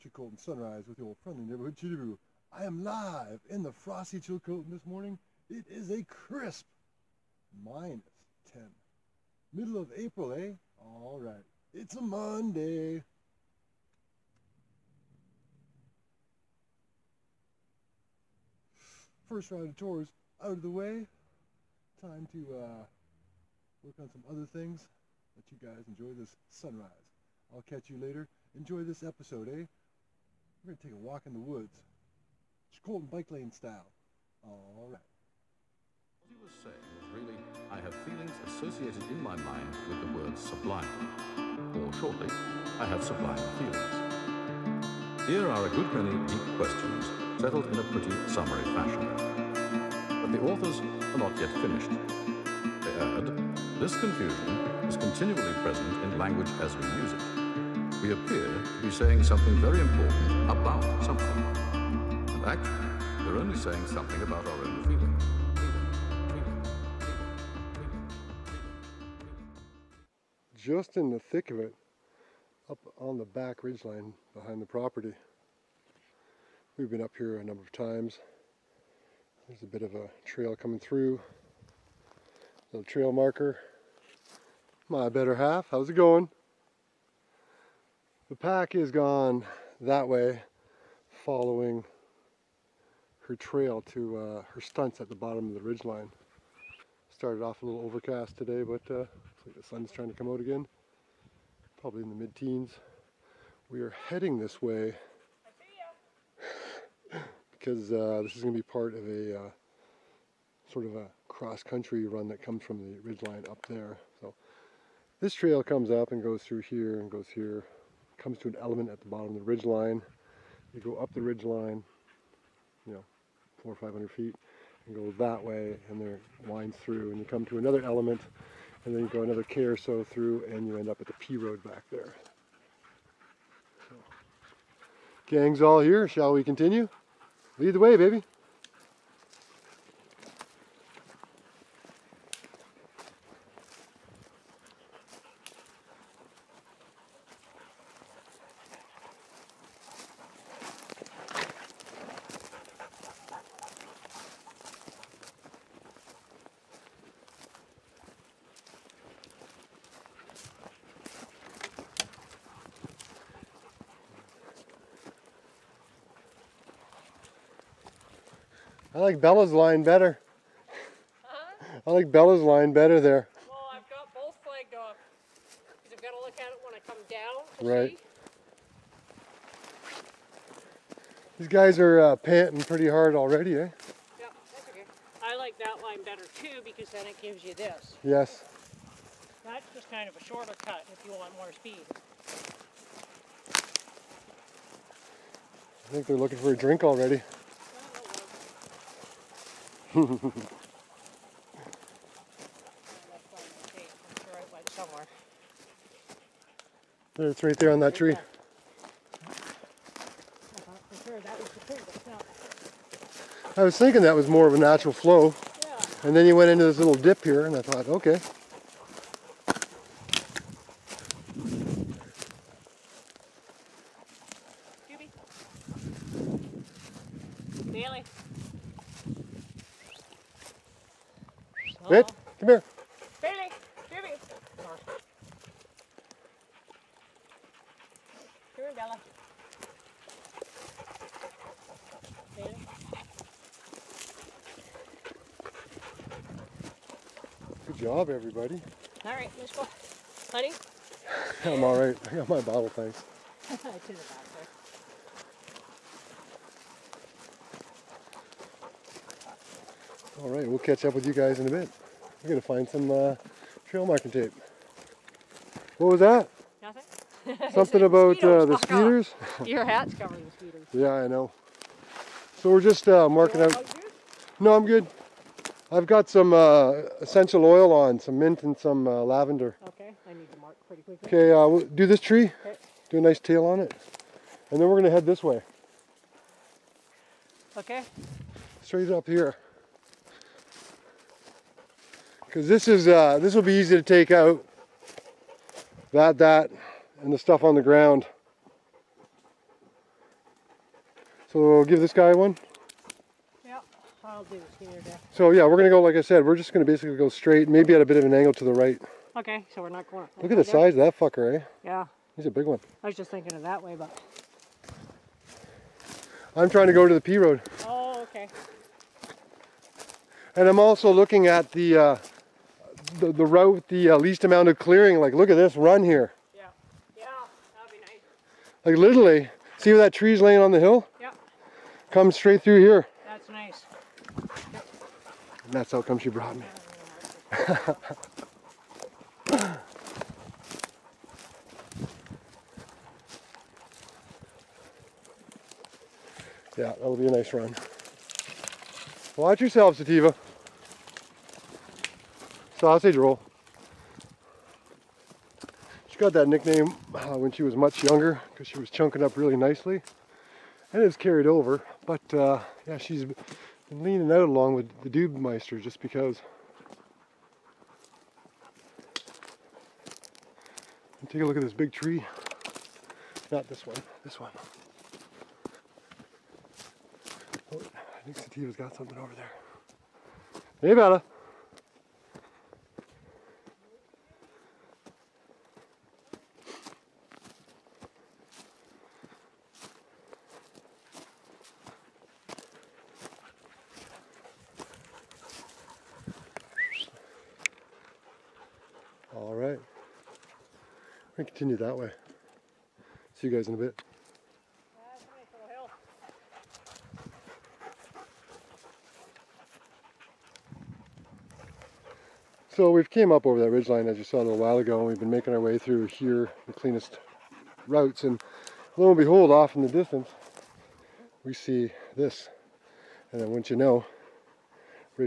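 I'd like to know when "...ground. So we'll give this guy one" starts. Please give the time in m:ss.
4:57.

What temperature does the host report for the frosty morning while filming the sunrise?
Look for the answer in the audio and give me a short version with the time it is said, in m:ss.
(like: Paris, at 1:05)
-10, at 0:07.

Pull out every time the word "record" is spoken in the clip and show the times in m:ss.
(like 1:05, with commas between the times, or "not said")
not said.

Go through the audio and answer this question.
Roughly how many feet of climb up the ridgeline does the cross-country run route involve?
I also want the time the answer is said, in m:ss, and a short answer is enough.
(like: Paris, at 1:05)
400 or 500 feet, at 2:03.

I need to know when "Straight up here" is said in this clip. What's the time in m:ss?
4:48.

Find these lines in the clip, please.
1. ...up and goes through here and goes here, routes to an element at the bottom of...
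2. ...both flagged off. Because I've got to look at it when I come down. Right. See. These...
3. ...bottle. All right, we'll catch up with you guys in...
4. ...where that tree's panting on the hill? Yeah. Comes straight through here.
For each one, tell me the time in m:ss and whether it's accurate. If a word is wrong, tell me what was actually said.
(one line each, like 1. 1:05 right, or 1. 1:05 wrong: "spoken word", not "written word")
1. 1:55 wrong: "comes", not "routes"
2. 2:54 right
3. 4:13 right
4. 5:29 wrong: "laying", not "panting".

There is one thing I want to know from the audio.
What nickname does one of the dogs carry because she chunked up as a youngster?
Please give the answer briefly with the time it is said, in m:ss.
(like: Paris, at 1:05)
Sativa sausage roll, at 5:49.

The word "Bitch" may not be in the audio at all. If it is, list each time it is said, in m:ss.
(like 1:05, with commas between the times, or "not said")
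3:52.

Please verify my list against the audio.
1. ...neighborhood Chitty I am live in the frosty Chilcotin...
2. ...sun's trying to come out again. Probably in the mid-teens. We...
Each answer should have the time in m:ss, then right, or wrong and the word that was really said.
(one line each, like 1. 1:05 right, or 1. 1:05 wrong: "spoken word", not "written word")
1. 0:01 right
2. 1:39 right.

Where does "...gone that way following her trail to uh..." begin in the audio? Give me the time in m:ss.
1:28.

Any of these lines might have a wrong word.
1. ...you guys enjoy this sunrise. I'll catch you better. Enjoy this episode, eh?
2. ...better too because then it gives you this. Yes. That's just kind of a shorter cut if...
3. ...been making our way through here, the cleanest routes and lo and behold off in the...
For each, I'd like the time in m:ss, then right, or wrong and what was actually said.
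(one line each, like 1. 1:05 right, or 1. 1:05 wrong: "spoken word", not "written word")
1. 0:25 wrong: "later", not "better"
2. 3:06 right
3. 6:54 right.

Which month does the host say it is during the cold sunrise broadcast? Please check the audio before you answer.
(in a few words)
April.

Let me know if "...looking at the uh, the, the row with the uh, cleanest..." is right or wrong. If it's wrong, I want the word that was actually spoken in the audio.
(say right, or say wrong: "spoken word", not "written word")
wrong: "least", not "cleanest".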